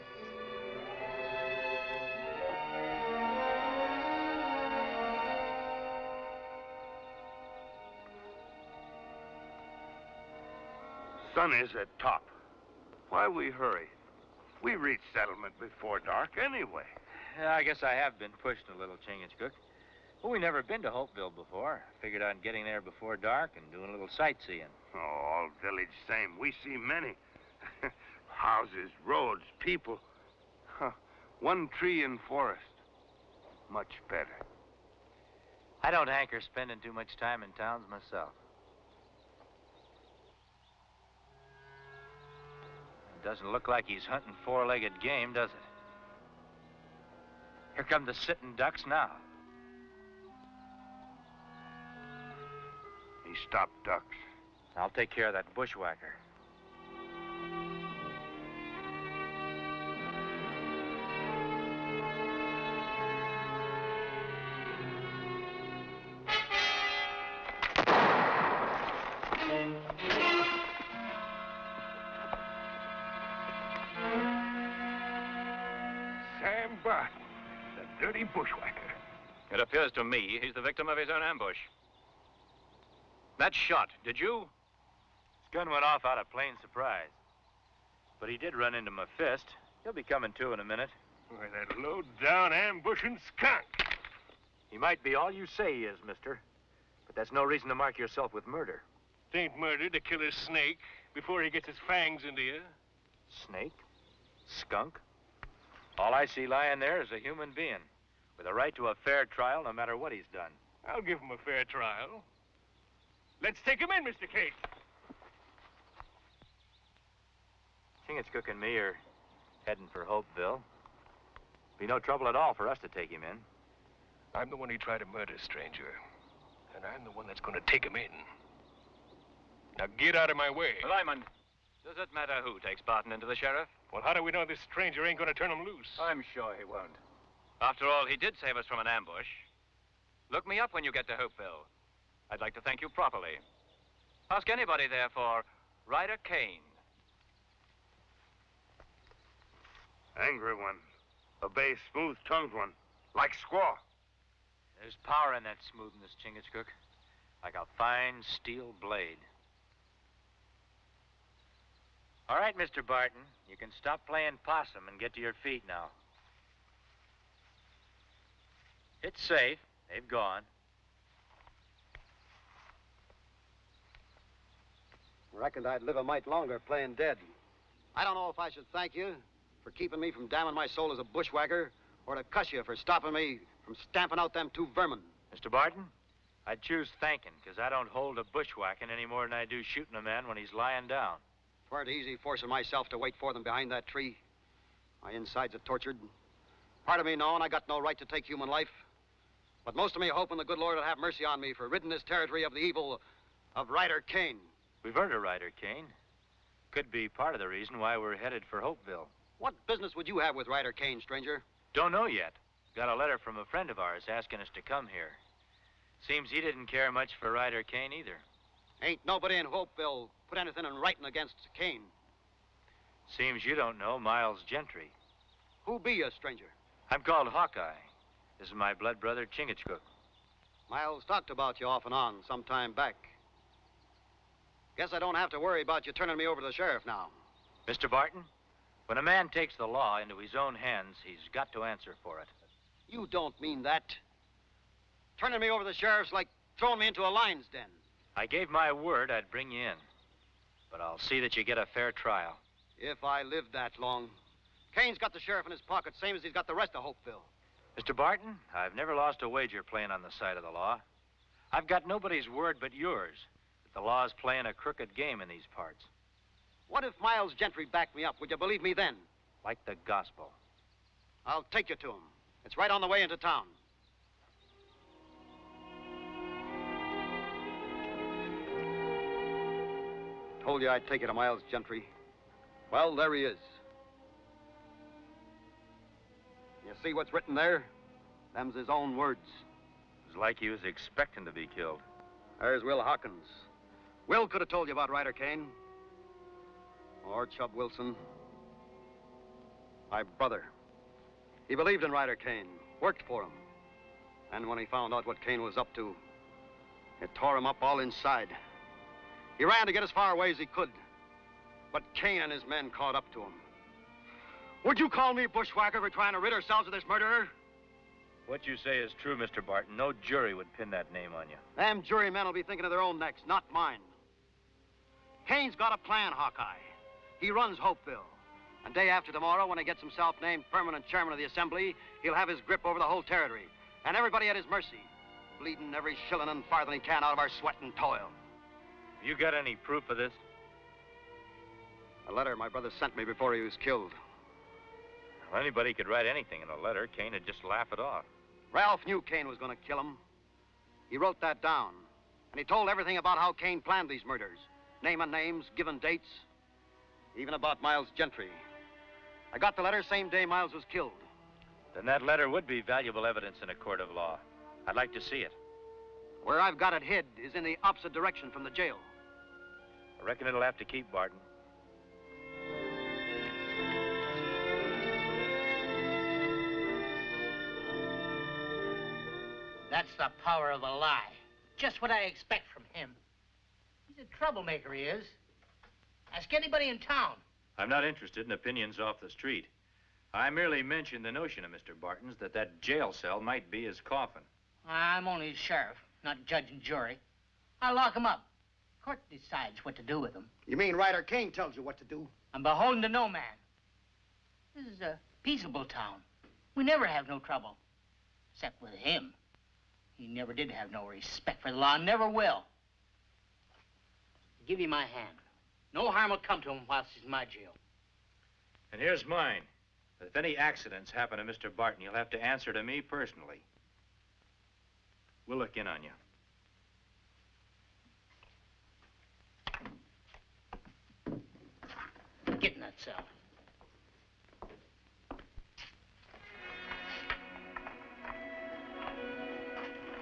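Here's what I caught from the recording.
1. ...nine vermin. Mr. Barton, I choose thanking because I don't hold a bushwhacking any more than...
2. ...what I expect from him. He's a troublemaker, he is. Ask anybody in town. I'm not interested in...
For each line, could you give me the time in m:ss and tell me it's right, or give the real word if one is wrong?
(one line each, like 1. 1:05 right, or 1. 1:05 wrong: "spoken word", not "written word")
1. 3:04 wrong: "two", not "nine"
2. 6:21 right.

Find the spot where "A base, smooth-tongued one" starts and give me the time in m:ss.
2:31.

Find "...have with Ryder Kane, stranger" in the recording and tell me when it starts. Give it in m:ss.
3:30.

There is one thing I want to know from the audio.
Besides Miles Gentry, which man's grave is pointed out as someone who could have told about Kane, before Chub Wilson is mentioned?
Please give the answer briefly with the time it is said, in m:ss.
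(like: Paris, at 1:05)
Will Hawkins, at 4:52.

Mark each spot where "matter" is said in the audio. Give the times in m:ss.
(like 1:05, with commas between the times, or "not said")
1:49, 2:12.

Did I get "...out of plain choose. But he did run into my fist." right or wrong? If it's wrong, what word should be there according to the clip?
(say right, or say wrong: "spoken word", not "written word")
wrong: "surprise", not "choose".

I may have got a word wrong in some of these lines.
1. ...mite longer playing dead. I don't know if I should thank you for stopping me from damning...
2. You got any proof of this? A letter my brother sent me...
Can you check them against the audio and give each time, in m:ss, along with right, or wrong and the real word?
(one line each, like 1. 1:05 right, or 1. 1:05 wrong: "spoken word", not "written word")
1. 2:56 wrong: "keeping", not "stopping"
2. 5:39 right.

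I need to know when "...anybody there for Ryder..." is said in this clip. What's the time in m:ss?
2:24.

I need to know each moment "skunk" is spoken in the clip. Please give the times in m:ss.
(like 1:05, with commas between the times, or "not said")
1:33, 1:44.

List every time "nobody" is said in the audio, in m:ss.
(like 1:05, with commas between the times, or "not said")
3:39, 4:21.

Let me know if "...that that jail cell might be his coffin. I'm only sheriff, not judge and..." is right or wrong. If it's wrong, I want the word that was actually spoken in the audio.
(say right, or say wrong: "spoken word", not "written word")
right.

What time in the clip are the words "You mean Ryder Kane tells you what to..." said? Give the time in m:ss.
6:40.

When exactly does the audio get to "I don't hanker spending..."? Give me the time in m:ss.
0:35.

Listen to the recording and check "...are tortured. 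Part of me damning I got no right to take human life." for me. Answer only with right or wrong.
wrong.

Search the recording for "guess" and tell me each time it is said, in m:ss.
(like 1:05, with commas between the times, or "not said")
0:17, 3:54.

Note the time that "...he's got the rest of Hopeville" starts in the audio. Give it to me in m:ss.
4:16.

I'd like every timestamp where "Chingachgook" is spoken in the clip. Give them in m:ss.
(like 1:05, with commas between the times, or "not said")
0:19, 1:58, 2:36, 3:49.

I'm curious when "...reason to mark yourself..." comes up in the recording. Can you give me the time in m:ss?
1:37.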